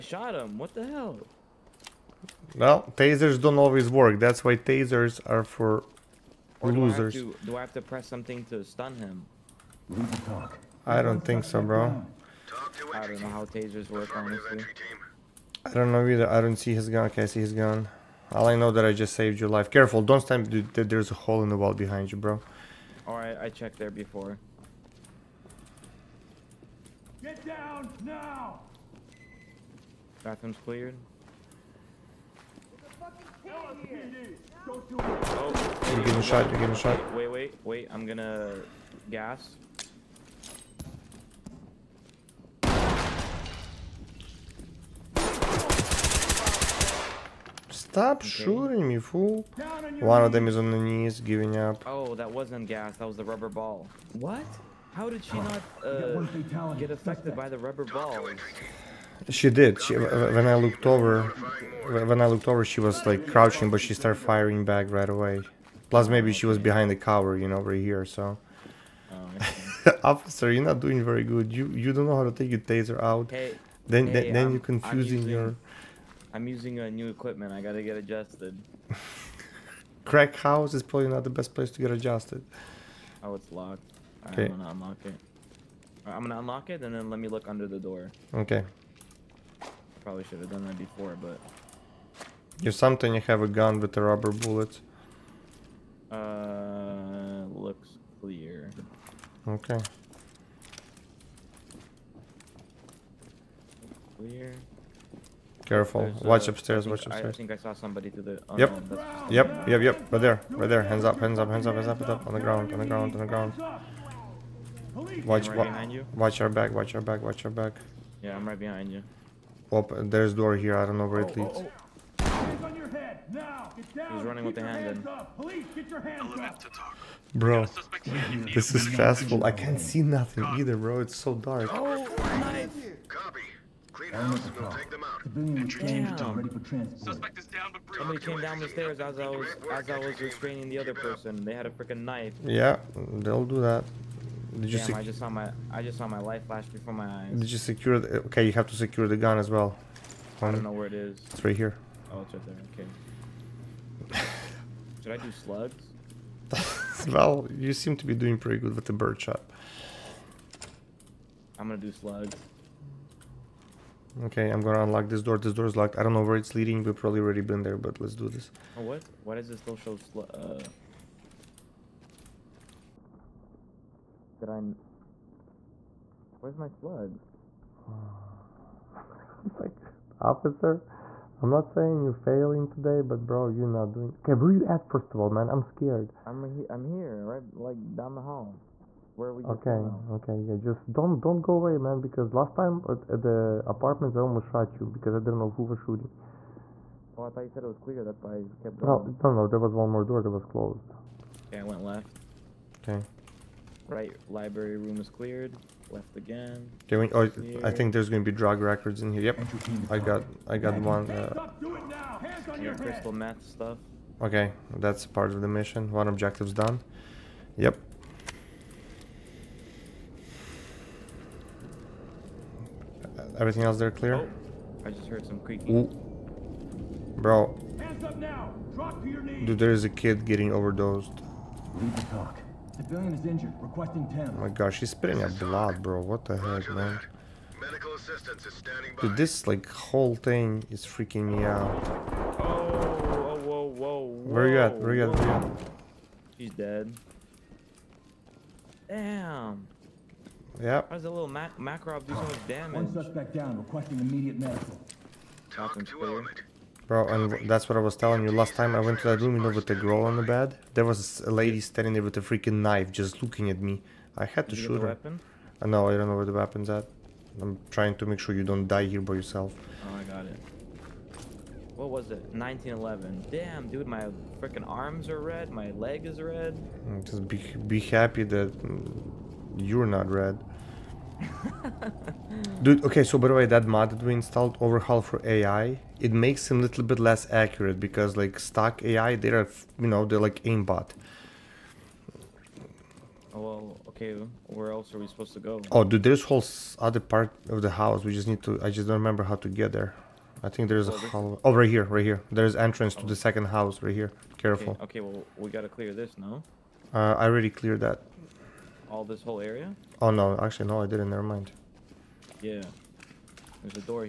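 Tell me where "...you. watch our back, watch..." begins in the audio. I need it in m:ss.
1:55.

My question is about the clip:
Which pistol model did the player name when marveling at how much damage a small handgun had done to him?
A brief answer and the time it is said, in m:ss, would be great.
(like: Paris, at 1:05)
Makarov, at 4:11.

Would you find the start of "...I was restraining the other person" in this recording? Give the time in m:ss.
2:19.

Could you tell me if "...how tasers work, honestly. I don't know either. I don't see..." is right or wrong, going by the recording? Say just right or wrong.
right.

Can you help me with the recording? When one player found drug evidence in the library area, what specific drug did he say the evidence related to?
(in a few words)
crystal meth.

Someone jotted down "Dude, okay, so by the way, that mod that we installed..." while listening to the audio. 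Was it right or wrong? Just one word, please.
right.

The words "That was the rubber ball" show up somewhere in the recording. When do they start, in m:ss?
0:52.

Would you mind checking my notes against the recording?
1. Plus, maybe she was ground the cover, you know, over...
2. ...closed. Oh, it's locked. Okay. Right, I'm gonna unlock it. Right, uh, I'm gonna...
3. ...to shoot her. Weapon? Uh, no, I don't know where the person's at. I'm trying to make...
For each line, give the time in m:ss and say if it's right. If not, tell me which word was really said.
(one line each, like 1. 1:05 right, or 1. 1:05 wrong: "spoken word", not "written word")
1. 1:05 wrong: "behind", not "ground"
2. 1:21 wrong: "adjusted", not "closed"
3. 4:24 wrong: "weapon", not "person".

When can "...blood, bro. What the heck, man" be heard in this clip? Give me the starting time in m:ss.
3:55.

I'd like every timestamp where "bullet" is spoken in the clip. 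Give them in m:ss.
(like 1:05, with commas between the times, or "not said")
1:34.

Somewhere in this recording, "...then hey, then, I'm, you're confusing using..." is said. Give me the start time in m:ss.
1:13.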